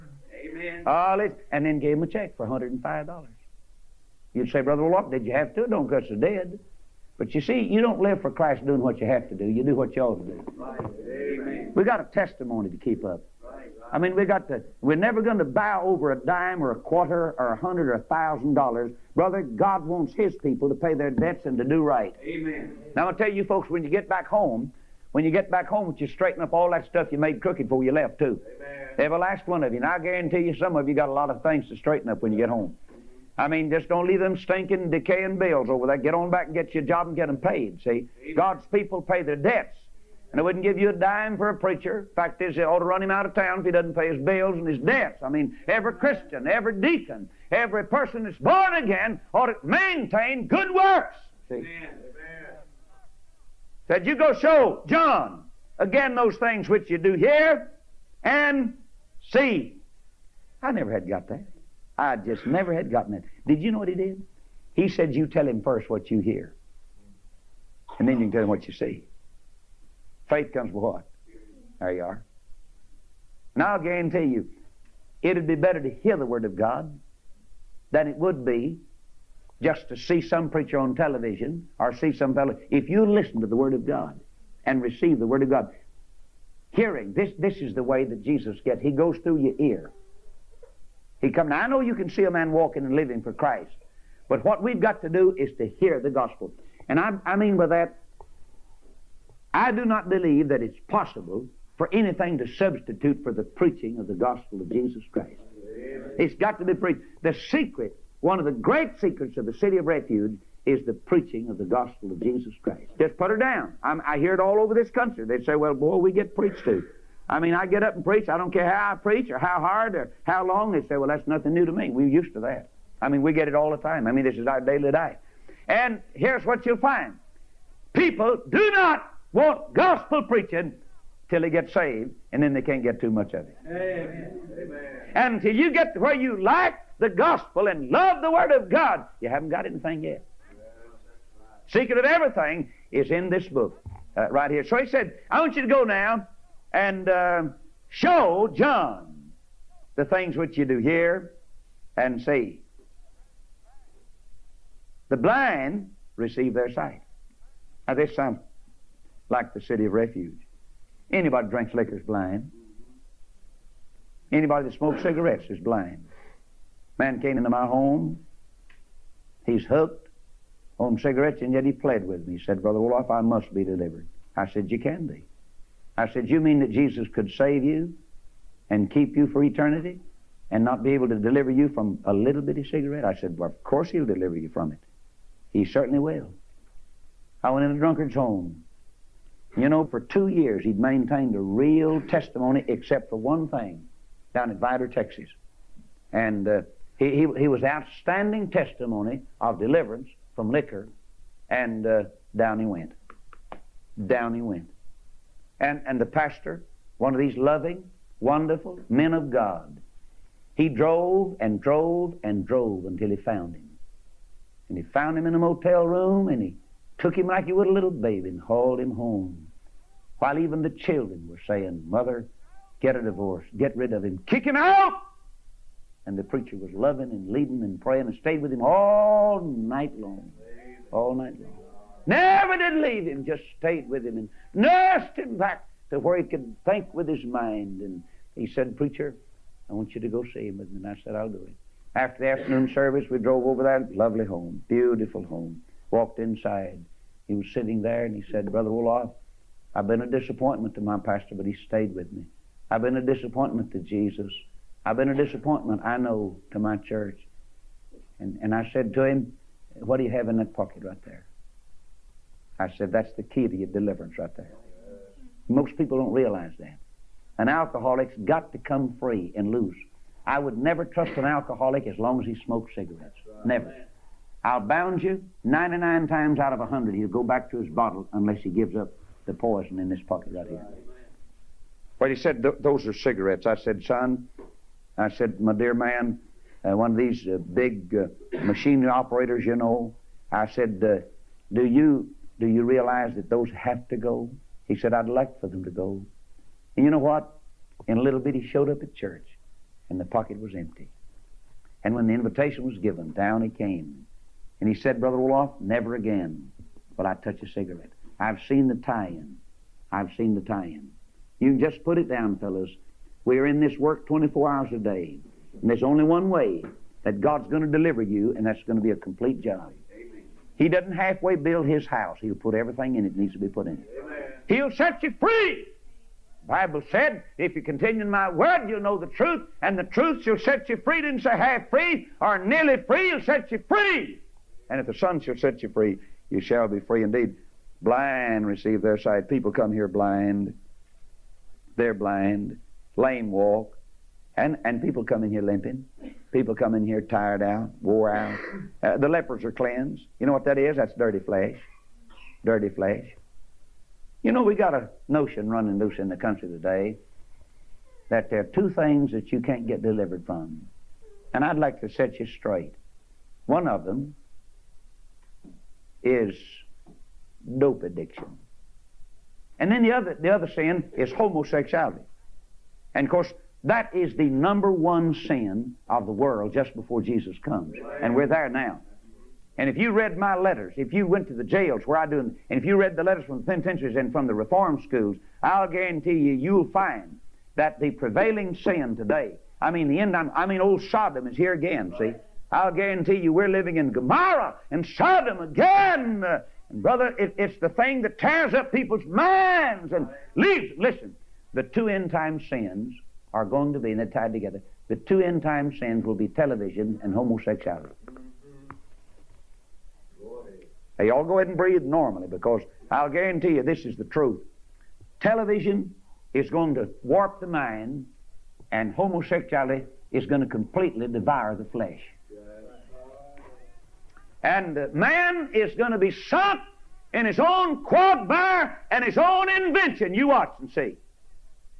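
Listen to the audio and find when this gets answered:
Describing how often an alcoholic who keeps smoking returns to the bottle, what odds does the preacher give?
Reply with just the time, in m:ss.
4:35.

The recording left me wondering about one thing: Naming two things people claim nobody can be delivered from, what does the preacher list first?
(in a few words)
Dope addiction.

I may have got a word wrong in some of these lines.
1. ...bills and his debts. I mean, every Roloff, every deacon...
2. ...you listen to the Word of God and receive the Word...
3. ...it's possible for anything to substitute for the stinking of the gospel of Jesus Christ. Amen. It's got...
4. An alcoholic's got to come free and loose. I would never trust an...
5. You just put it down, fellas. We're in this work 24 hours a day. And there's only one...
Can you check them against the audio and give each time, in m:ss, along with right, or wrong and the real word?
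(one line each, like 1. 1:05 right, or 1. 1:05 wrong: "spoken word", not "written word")
1. 0:44 wrong: "Christian", not "Roloff"
2. 1:22 right
3. 1:40 wrong: "preaching", not "stinking"
4. 4:27 right
5. 5:11 right.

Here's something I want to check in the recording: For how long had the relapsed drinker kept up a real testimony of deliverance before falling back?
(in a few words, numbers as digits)
2 years.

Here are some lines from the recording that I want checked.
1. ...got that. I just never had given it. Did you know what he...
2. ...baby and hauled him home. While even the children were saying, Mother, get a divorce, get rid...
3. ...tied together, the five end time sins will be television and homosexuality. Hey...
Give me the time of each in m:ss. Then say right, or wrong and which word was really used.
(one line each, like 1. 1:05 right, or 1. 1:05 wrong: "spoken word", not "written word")
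1. 1:01 wrong: "gotten", not "given"
2. 3:37 right
3. 6:44 wrong: "two", not "five".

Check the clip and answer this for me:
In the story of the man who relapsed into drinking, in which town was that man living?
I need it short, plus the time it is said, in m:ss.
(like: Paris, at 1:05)
Vidor, Texas, at 3:14.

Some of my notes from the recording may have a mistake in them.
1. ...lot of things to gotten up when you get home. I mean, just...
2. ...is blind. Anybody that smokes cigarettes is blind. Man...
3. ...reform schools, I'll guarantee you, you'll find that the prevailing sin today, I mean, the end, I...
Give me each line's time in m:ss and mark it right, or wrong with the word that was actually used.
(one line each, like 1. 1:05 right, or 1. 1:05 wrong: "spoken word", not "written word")
1. 0:31 wrong: "straighten", not "gotten"
2. 2:41 right
3. 6:24 right.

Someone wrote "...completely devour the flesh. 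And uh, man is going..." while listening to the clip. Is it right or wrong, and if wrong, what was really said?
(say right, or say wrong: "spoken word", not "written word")
right.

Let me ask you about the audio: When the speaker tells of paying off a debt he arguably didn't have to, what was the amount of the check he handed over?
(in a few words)
$105.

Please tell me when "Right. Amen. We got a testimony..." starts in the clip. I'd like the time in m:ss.
0:10.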